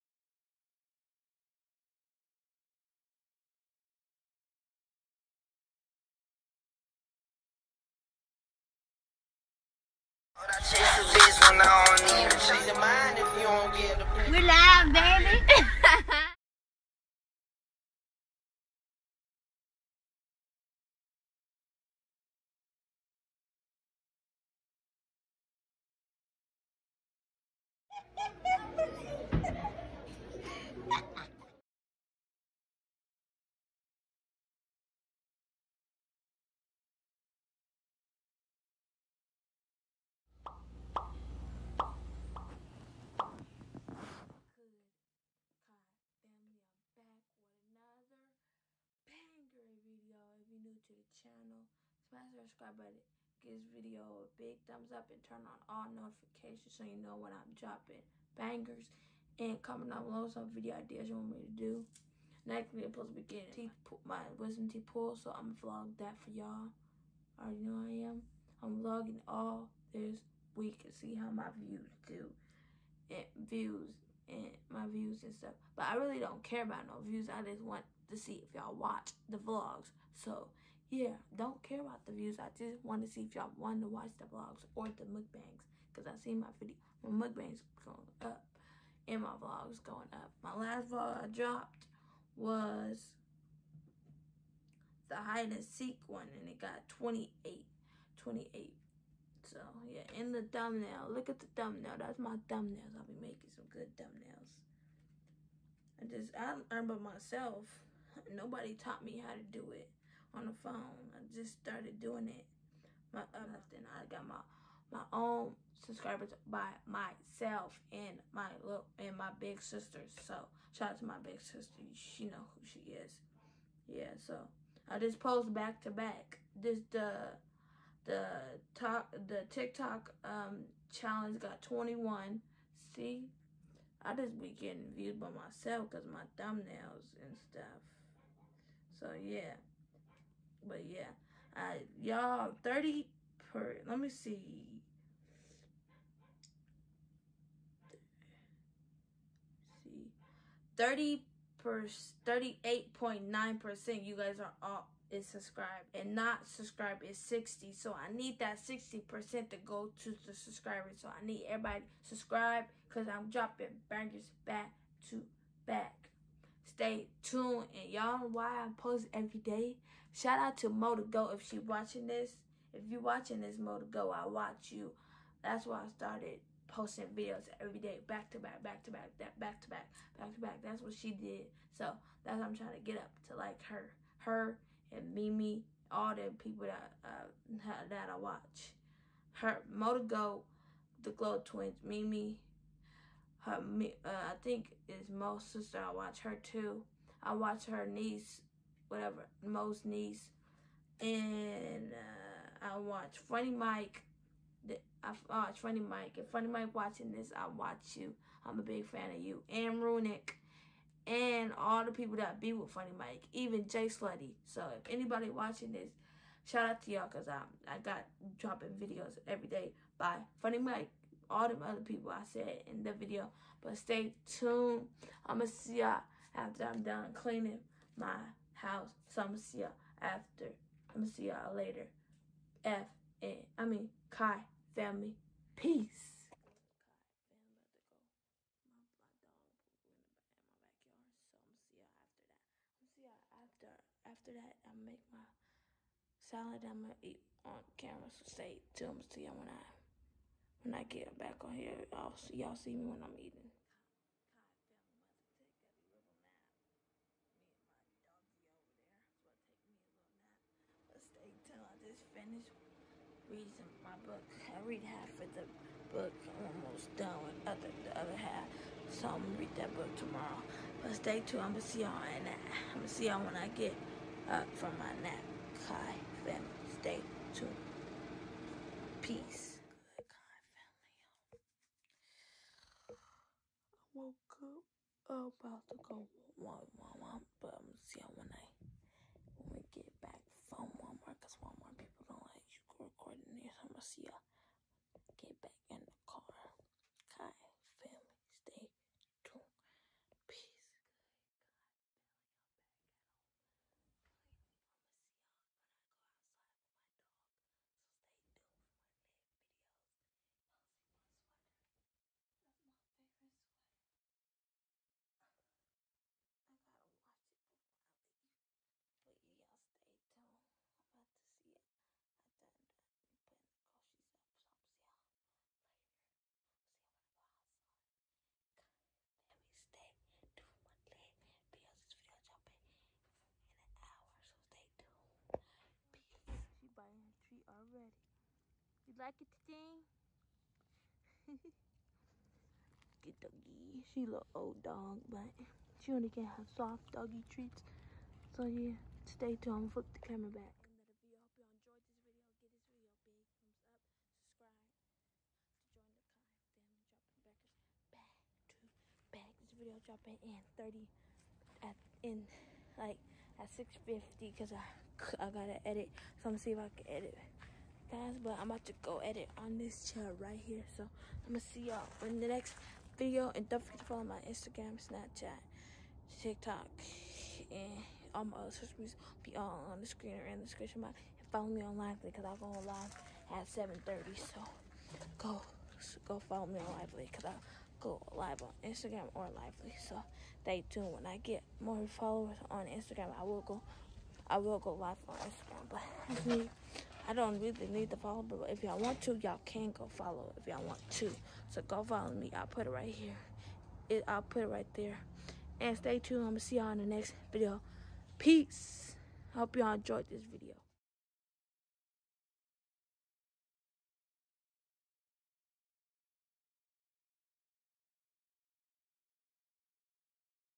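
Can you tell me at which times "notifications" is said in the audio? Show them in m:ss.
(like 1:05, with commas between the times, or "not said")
0:55.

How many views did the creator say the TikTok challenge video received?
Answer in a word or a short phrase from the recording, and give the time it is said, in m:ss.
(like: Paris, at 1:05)
21, at 2:11.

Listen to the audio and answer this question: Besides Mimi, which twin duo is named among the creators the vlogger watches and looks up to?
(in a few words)
Glow Twins.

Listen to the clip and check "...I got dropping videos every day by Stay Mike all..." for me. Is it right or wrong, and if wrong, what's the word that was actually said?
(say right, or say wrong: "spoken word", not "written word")
wrong: "Funny", not "Stay".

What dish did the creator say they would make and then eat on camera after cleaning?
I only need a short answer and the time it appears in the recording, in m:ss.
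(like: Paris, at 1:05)
Salad, at 4:06.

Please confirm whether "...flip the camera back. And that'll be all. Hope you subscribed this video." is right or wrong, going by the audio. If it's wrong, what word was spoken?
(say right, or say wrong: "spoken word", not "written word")
wrong: "enjoyed", not "subscribed".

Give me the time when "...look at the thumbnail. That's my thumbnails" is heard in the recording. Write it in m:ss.
1:41.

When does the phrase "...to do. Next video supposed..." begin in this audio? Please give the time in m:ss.
1:01.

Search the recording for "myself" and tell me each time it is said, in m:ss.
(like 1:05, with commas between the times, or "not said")
1:46, 1:56, 2:15.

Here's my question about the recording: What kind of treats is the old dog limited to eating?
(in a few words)
Soft doggy treats.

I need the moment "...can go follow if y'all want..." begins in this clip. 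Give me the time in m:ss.
6:39.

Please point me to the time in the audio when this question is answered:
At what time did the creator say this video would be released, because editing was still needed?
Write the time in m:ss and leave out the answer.
6:03.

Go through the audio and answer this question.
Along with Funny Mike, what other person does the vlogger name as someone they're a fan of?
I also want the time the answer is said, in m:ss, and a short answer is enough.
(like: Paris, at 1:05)
Runic, at 3:29.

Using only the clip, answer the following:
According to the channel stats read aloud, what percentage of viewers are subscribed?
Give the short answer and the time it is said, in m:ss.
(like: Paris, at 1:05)
38.9%, at 2:32.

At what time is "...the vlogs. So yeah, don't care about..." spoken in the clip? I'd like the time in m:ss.
1:19.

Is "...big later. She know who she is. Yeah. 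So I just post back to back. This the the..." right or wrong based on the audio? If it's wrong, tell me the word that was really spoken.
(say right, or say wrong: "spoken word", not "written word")
wrong: "sister", not "later".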